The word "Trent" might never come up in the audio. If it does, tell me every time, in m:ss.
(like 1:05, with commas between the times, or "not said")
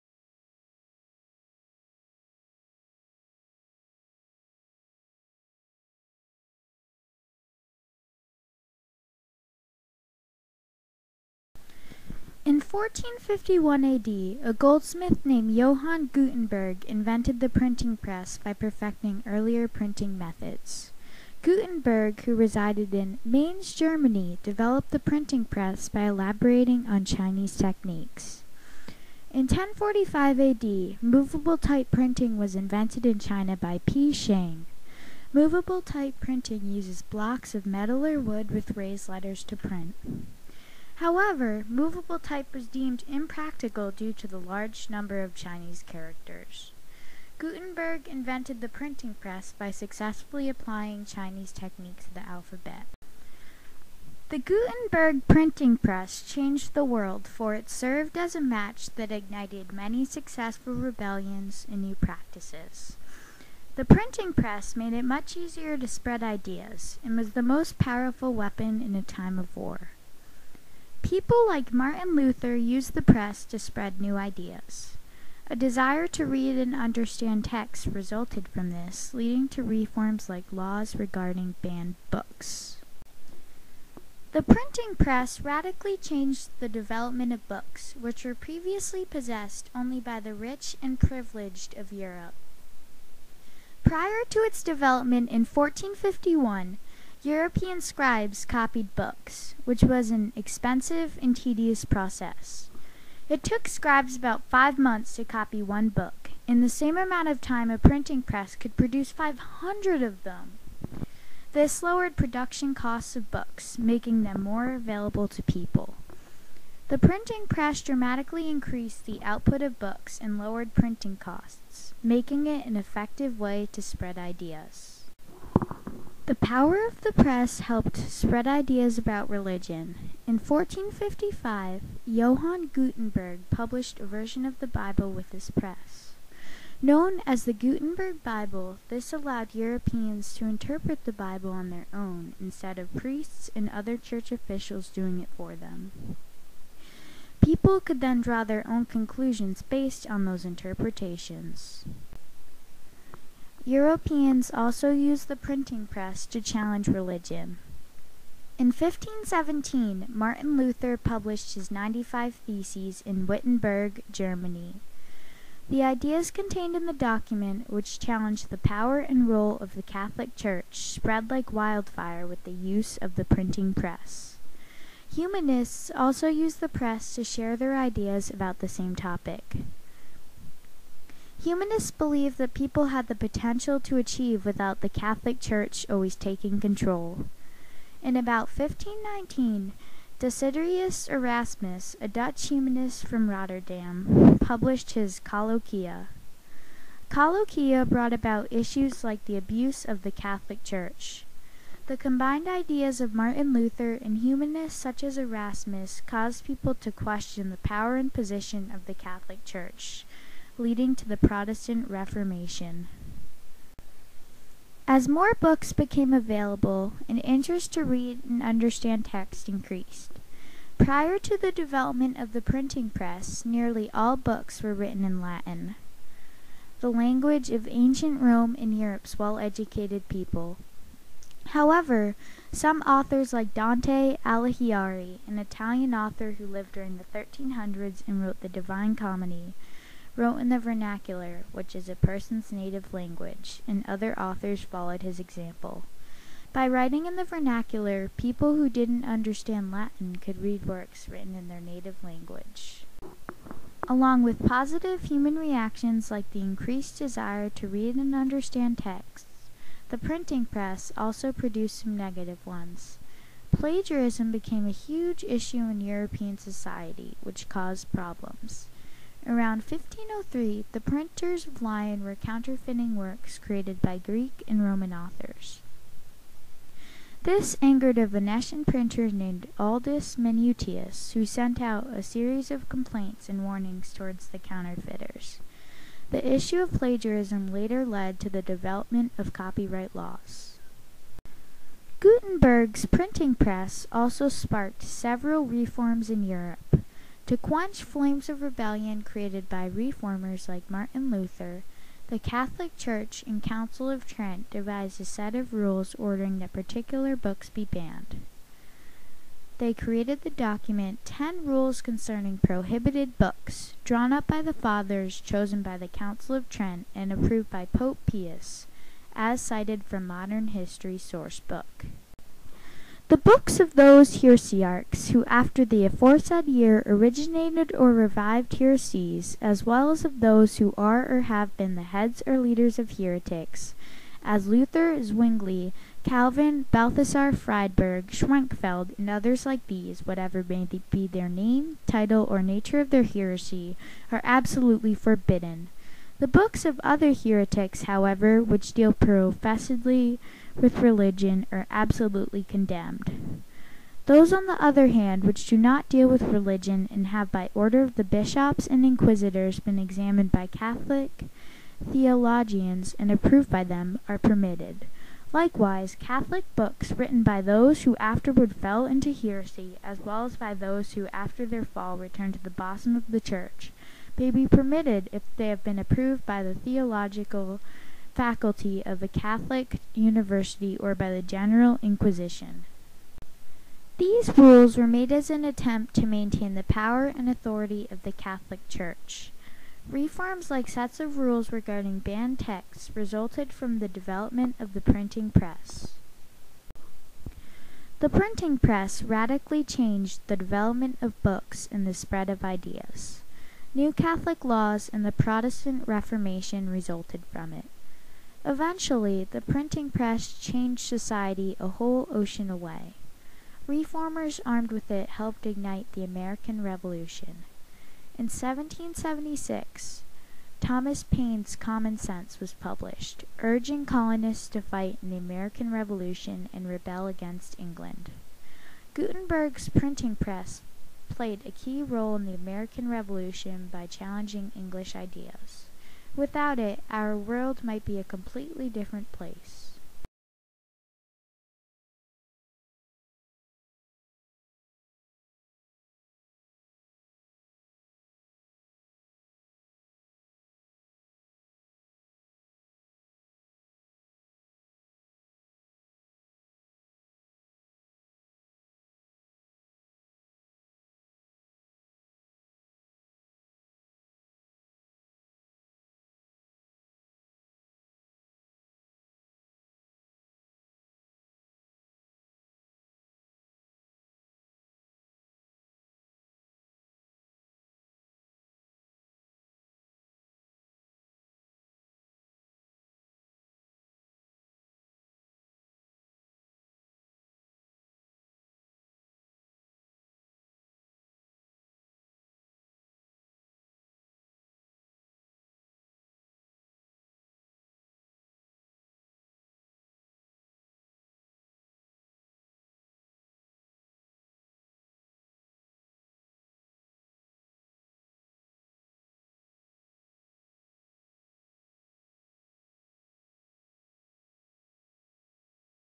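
5:04, 5:16.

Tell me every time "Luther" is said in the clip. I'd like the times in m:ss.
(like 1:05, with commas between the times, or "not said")
1:12, 2:40, 3:23, 5:01, 5:34.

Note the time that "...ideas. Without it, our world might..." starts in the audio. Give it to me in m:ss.
7:14.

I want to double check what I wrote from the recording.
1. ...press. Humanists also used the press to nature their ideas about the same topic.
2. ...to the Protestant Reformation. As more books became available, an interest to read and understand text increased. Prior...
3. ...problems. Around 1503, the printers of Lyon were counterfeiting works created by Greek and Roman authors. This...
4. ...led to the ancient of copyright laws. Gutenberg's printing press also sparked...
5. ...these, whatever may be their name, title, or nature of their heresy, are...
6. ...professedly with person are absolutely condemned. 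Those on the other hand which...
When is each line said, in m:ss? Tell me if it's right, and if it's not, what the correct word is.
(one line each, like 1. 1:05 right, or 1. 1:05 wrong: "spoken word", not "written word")
1. 2:53 wrong: "share", not "nature"
2. 3:30 right
3. 4:27 right
4. 4:47 wrong: "development", not "ancient"
5. 5:39 right
6. 5:48 wrong: "religion", not "person".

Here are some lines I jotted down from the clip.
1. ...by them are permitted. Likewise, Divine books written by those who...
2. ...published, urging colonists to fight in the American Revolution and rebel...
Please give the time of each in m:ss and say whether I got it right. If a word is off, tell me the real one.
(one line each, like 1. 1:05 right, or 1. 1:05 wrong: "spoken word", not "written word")
1. 6:03 wrong: "Catholic", not "Divine"
2. 7:02 right.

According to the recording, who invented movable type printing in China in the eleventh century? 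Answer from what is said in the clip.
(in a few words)
Pi Shang.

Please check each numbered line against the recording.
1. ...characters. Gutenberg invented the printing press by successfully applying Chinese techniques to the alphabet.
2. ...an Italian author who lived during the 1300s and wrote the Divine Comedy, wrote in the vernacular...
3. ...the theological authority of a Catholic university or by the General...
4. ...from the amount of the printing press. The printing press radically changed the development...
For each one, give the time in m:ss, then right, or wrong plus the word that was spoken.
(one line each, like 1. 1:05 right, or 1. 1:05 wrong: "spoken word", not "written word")
1. 0:45 right
2. 3:55 right
3. 6:16 wrong: "faculty", not "authority"
4. 6:33 wrong: "development", not "amount".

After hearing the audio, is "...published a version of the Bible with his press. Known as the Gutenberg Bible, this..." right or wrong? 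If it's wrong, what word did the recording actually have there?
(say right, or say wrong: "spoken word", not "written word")
right.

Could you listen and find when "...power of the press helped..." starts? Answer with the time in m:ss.
2:06.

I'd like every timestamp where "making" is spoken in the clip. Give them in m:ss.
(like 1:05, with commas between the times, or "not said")
1:53, 2:02.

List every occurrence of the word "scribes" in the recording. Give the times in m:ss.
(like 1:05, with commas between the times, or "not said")
1:37, 1:43.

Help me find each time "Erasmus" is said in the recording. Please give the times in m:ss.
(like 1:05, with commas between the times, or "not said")
3:11, 3:25.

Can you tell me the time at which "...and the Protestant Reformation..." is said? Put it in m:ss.
6:44.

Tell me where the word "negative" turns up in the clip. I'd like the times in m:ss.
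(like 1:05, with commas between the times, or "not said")
4:21.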